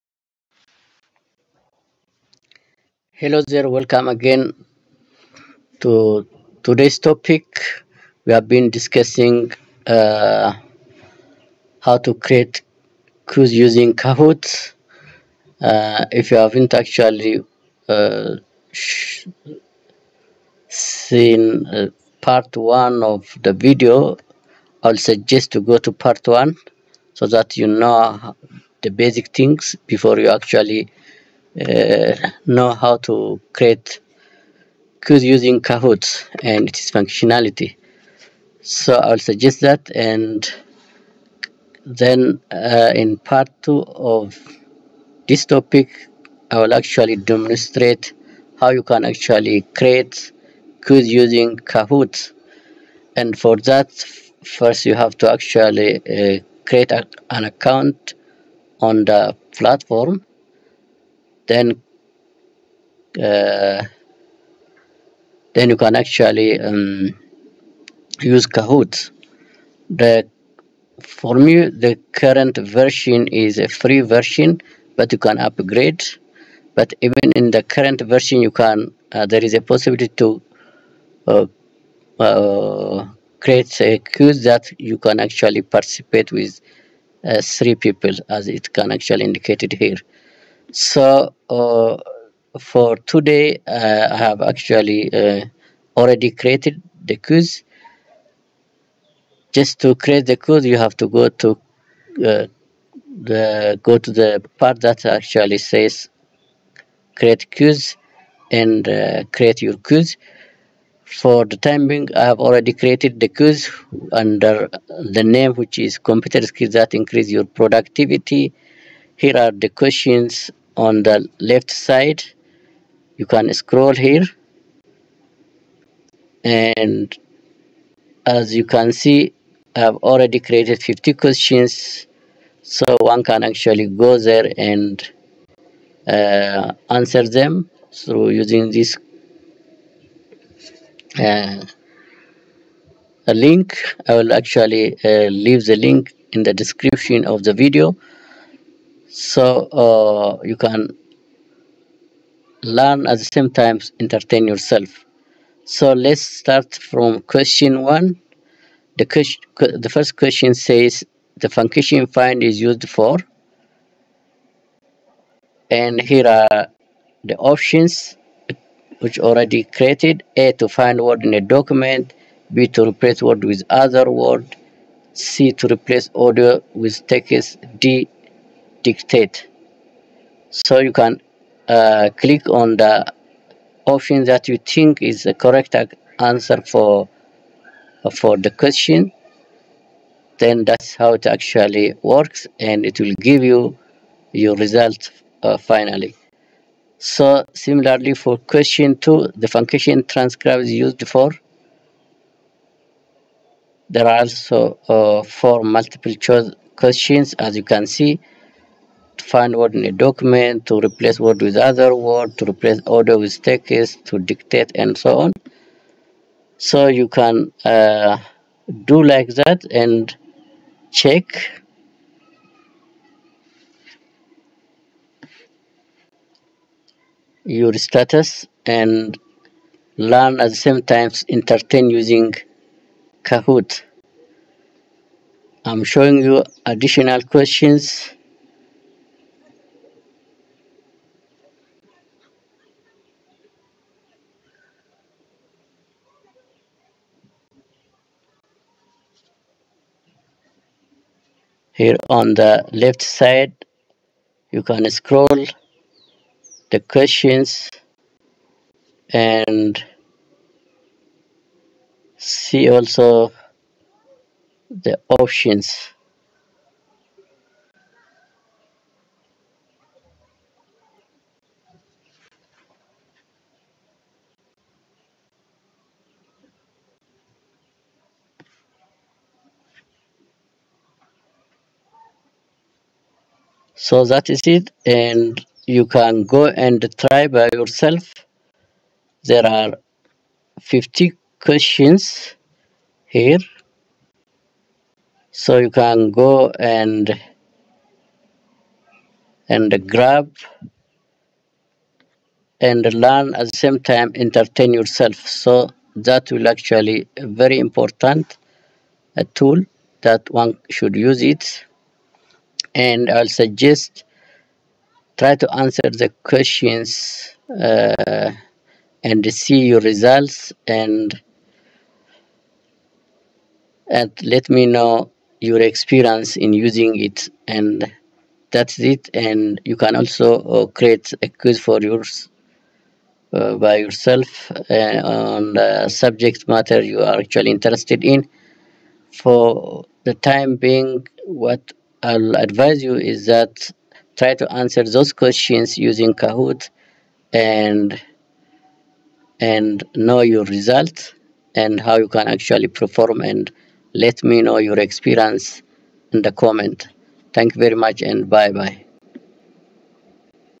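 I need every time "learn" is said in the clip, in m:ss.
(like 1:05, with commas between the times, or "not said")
2:32, 3:49, 5:02.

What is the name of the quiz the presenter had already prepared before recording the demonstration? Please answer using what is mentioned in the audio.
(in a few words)
computer skills that increase your productivity.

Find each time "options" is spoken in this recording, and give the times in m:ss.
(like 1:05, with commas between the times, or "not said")
2:47, 3:03, 4:25.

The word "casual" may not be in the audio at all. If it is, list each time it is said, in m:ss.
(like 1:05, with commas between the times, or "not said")
not said.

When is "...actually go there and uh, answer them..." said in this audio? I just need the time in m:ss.
2:13.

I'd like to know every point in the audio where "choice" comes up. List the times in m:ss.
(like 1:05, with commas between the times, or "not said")
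3:26.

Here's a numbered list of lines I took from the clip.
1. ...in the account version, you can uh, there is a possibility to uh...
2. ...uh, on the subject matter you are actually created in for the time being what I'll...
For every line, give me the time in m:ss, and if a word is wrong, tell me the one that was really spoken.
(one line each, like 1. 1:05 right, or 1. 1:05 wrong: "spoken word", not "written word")
1. 1:17 wrong: "current", not "account"
2. 5:34 wrong: "interested", not "created".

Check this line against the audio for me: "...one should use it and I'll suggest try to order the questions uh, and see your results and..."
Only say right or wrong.
wrong.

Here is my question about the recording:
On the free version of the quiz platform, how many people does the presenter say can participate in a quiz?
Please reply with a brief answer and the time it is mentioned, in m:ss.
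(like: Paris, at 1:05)
3, at 1:27.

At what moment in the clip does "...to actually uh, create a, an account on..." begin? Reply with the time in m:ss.
0:55.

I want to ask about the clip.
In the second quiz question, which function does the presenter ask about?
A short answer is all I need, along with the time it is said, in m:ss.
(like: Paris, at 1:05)
transcribe, at 3:20.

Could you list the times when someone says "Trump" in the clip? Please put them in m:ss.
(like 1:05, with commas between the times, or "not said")
not said.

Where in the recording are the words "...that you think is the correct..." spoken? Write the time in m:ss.
3:04.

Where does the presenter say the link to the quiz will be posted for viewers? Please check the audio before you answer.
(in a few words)
description of the video.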